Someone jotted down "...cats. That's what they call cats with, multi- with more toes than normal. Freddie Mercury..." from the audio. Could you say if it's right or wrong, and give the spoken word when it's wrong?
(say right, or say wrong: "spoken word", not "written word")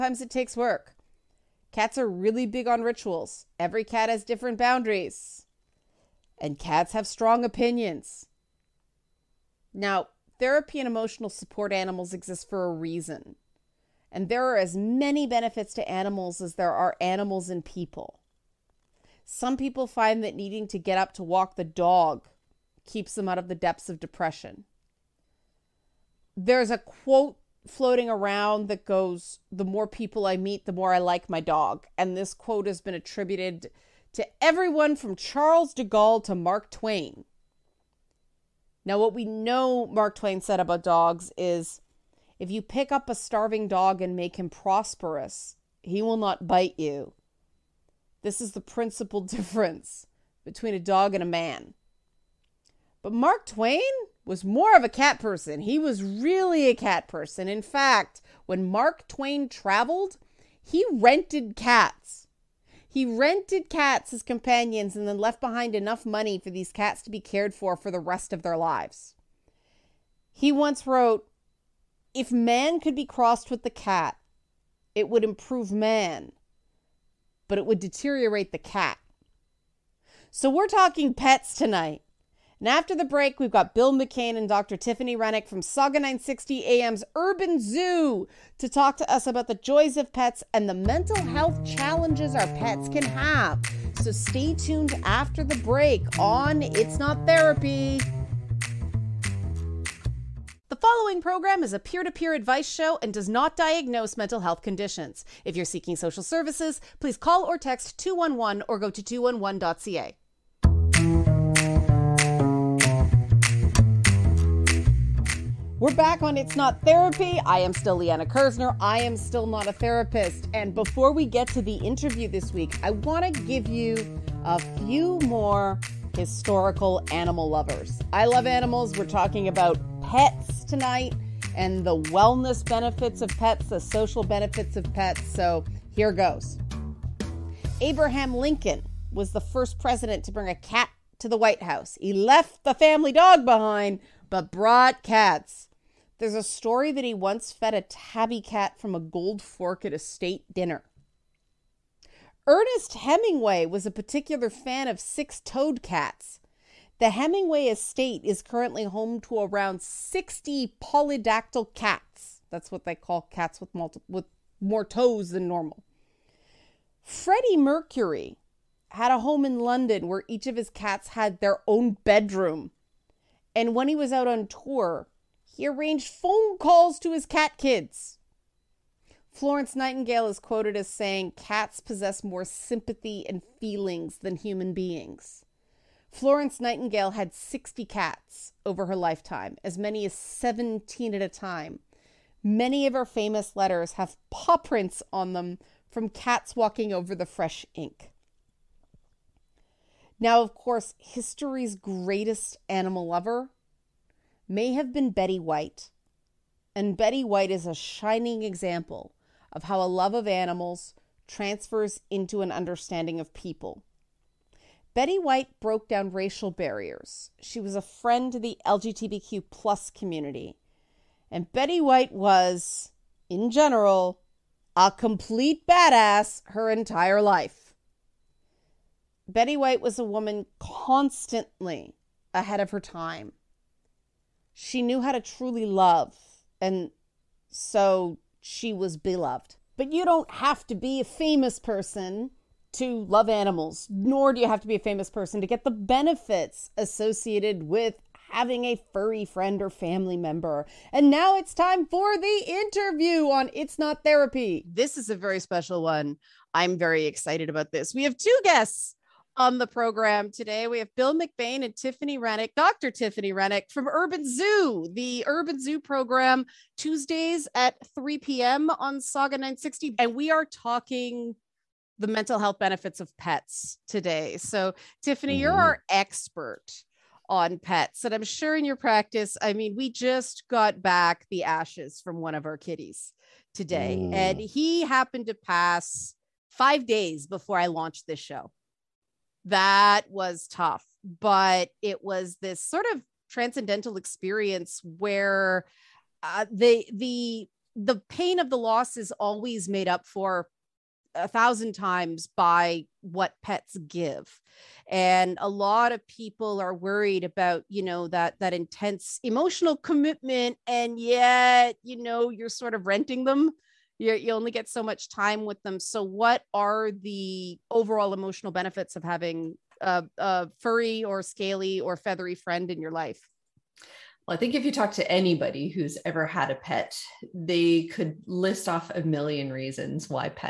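right.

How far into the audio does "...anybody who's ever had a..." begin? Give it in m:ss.
5:25.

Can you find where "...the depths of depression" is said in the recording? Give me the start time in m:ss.
0:23.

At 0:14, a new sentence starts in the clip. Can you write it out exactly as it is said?
And there are as many benefits to animals as there are animals and people.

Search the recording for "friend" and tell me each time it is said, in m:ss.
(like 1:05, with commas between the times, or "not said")
3:37, 4:09, 5:22.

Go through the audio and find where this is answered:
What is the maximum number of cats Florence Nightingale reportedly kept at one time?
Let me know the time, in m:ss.
3:10.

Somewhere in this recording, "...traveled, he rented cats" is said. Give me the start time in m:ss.
0:59.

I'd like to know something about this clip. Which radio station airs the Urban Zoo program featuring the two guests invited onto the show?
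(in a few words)
Sauga 960 AM.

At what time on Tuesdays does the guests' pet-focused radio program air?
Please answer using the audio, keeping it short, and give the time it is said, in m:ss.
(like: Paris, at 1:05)
3 p.m., at 4:27.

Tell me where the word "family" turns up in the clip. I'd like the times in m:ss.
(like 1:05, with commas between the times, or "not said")
2:22, 4:09.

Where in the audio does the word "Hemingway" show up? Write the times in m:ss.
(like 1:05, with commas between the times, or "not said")
2:32, 2:37.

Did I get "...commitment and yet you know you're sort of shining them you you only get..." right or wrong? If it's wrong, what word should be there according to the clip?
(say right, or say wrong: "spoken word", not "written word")
wrong: "renting", not "shining".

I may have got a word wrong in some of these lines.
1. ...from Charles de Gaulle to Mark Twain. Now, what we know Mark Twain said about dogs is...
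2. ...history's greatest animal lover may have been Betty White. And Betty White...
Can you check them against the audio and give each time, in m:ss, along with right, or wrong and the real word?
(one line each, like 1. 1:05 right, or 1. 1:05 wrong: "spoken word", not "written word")
1. 0:34 right
2. 3:20 right.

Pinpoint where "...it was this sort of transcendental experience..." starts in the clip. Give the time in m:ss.
4:51.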